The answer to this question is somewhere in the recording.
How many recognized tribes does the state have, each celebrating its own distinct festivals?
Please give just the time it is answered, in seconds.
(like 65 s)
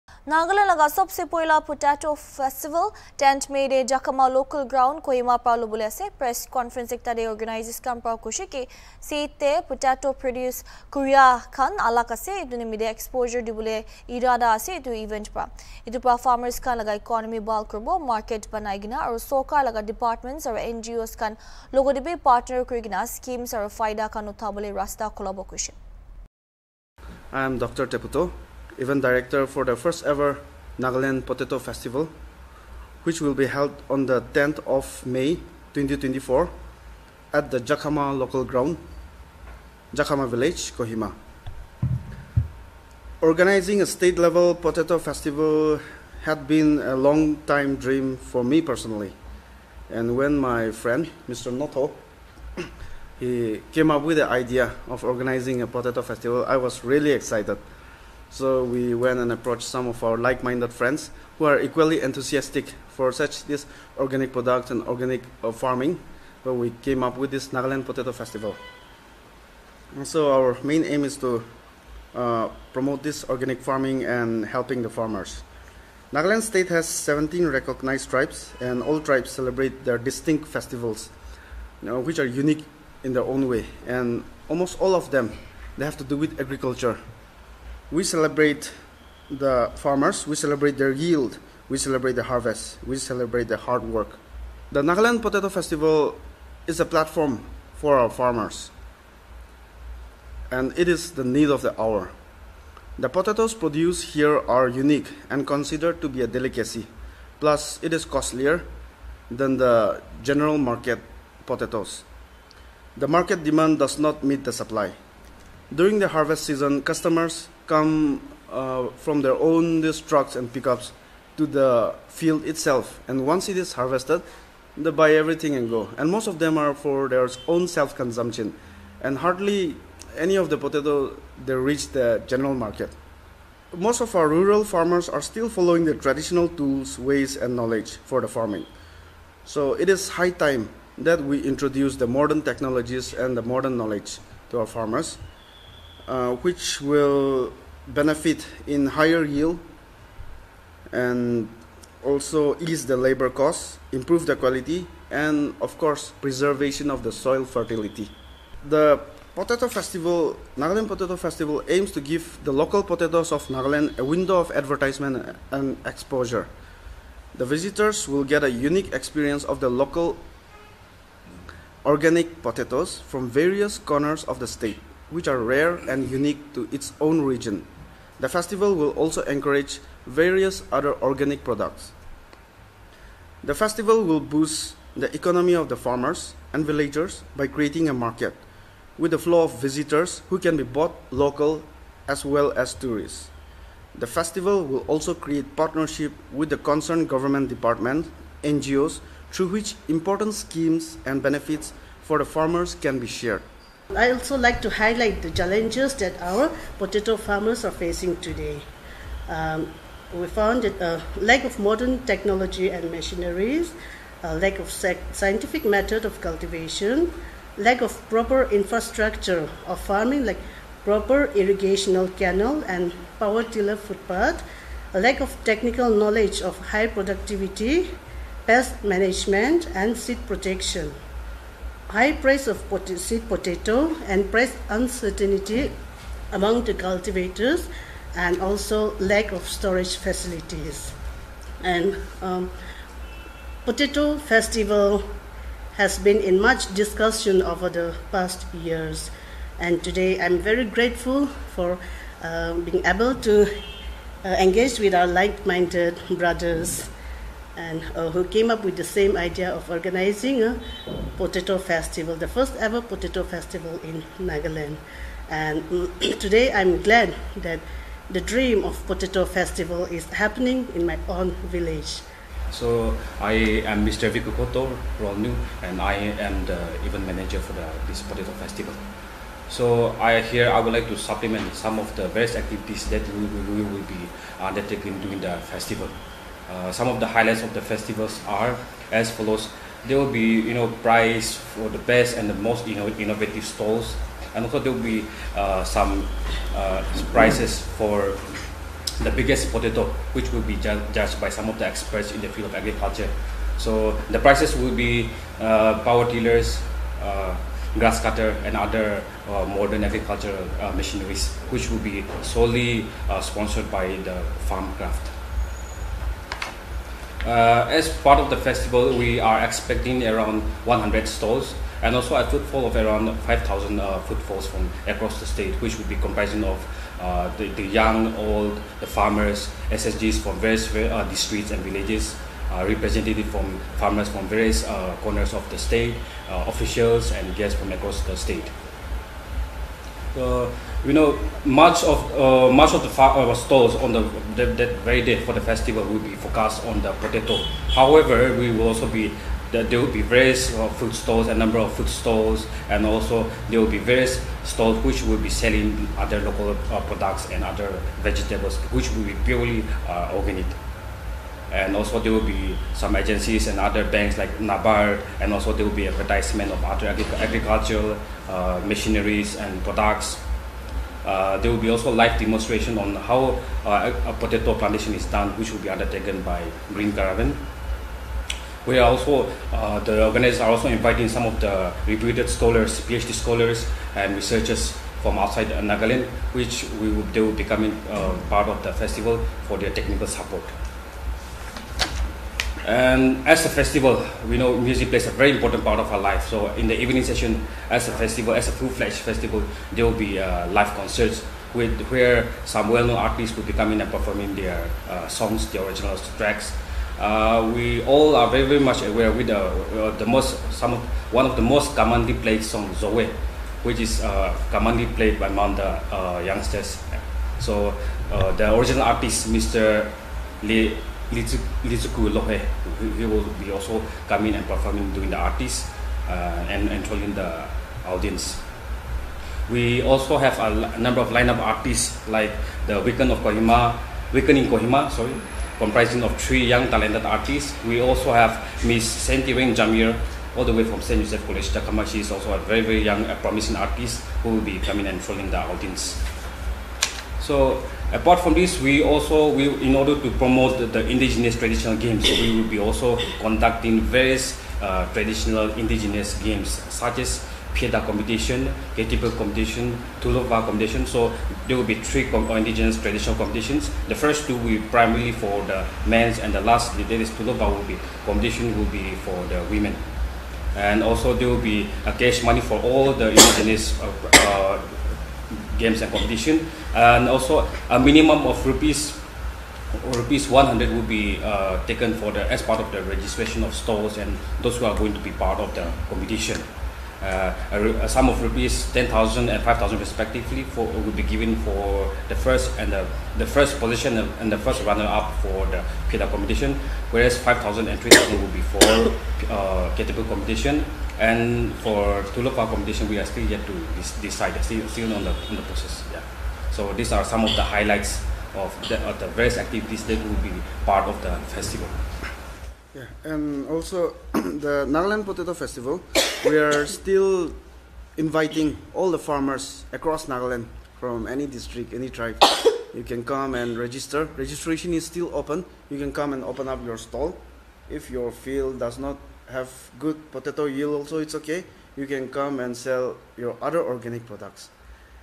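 76 s.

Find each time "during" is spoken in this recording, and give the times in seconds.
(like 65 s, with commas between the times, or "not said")
115 s, 285 s.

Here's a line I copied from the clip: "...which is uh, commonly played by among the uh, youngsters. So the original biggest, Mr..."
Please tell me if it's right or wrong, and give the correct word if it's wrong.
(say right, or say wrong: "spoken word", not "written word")
wrong: "artist", not "biggest".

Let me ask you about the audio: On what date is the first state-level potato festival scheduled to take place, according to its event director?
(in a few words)
10 May 2024.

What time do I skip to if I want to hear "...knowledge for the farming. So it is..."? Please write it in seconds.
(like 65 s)
137 s.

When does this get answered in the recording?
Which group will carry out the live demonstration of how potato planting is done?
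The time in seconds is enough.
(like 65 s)
376 s.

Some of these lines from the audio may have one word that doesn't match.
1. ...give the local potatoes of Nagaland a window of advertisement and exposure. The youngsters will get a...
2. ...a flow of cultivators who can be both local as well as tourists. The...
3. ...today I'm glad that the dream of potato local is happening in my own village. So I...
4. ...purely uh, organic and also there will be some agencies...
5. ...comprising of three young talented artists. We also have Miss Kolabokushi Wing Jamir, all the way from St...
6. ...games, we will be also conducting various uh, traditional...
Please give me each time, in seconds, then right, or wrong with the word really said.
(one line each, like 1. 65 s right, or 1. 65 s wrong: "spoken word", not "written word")
1. 162 s wrong: "visitors", not "youngsters"
2. 189 s wrong: "visitors", not "cultivators"
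3. 266 s wrong: "festival", not "local"
4. 359 s right
5. 435 s wrong: "Santi", not "Kolabokushi"
6. 451 s right.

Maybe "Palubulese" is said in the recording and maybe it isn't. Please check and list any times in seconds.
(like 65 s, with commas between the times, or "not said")
5 s.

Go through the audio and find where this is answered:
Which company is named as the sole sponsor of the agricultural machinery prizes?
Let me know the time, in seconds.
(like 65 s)
314 s.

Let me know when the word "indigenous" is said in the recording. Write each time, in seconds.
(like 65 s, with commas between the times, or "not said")
450 s, 455 s, 462 s, 473 s.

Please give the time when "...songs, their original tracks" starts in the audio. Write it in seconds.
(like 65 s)
405 s.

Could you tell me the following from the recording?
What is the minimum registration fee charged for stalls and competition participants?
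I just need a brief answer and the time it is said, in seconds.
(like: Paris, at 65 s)
100 rupees, at 479 s.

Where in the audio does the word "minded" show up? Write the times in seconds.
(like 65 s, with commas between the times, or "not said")
60 s, 255 s.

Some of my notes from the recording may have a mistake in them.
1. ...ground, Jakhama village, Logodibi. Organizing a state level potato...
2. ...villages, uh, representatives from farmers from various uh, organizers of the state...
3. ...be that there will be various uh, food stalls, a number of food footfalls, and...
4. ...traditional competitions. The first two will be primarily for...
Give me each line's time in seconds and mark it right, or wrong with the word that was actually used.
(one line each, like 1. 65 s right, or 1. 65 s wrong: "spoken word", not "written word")
1. 38 s wrong: "Kohima", not "Logodibi"
2. 331 s wrong: "corners", not "organizers"
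3. 348 s wrong: "stalls", not "footfalls"
4. 462 s right.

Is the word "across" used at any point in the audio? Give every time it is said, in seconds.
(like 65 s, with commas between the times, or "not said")
324 s, 337 s, 519 s.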